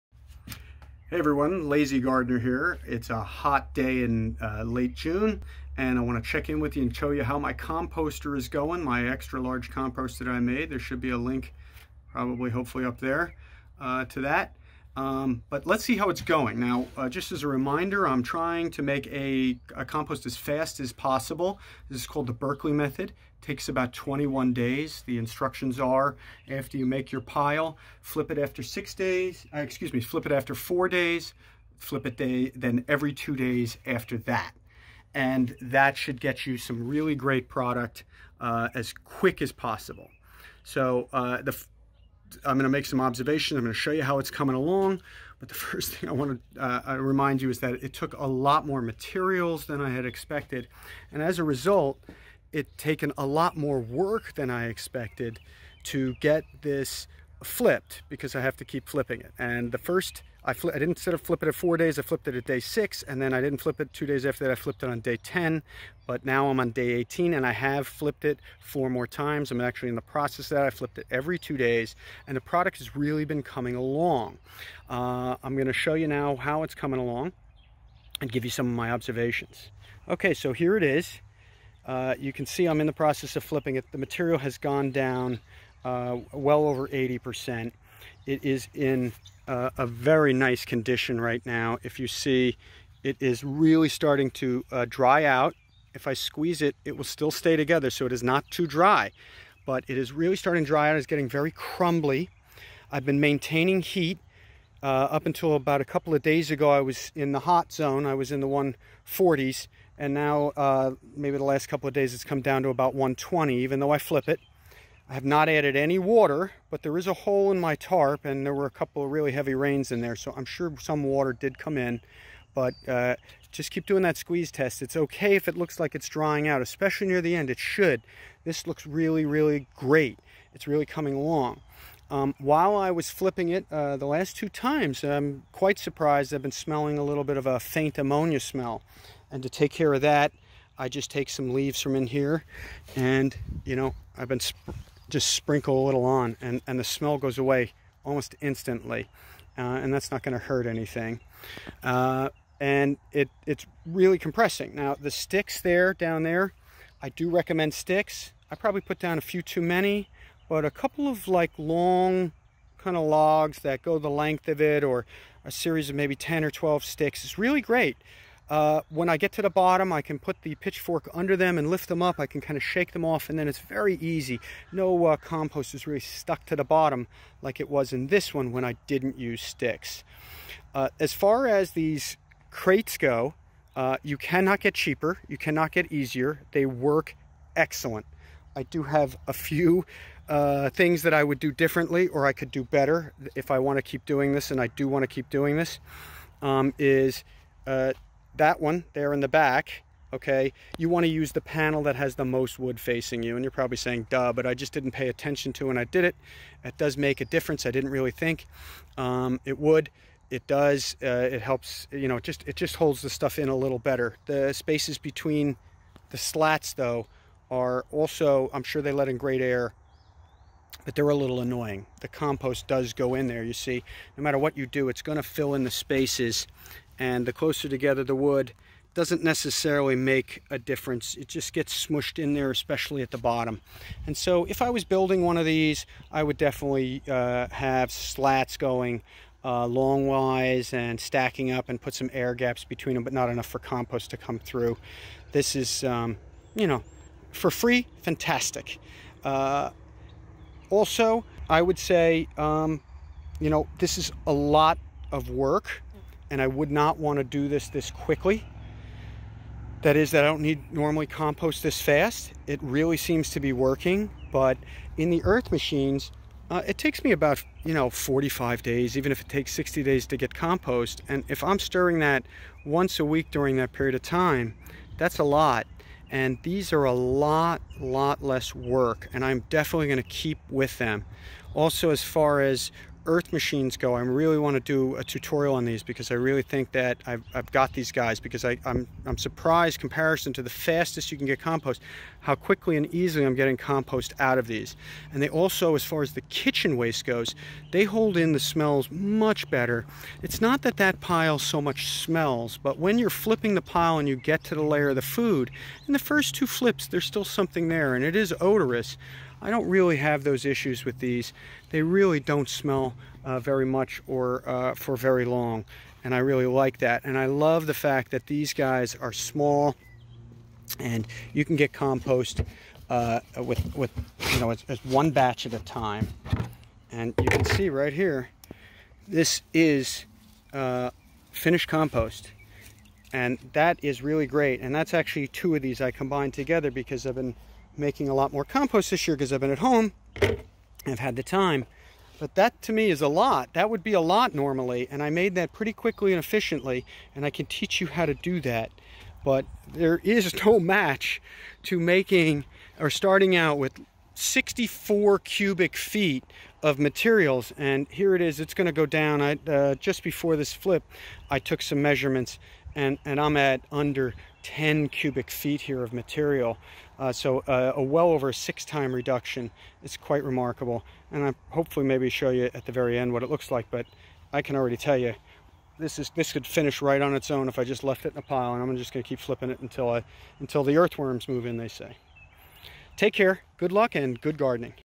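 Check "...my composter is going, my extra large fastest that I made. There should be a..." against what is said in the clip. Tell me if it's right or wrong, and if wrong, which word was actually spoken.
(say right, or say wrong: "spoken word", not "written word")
wrong: "compost", not "fastest".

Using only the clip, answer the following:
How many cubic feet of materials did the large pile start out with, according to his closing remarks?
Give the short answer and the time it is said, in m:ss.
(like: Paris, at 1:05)
64 cubic feet, at 5:54.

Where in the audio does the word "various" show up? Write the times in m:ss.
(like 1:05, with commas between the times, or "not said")
not said.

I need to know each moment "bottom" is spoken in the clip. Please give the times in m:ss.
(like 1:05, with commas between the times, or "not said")
2:49, 2:56, 3:53.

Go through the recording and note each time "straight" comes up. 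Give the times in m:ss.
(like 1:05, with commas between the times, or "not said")
not said.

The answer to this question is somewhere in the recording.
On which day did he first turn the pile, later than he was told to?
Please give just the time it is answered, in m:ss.
1:02.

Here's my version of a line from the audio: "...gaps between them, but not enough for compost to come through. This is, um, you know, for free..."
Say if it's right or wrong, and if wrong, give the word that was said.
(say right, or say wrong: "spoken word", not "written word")
right.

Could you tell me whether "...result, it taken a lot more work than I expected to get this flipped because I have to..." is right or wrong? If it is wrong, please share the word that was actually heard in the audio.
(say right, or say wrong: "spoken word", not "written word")
right.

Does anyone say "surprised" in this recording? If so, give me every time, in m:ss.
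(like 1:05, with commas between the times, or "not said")
2:15, 4:49.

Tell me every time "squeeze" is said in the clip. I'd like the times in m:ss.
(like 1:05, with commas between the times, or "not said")
1:36, 2:04.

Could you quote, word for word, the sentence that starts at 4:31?
And if I'm stirring that once a week during that period of time, that's a lot.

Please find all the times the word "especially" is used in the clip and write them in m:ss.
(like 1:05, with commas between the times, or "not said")
2:06, 3:52.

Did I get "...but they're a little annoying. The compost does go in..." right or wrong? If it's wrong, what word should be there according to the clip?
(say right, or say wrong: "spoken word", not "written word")
right.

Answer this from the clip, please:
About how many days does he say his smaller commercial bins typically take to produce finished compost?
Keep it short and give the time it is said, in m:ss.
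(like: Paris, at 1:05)
45 days, at 4:27.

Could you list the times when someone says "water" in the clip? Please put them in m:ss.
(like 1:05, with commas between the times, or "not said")
1:55, 2:01.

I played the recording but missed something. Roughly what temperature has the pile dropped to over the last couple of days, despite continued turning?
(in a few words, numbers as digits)
120.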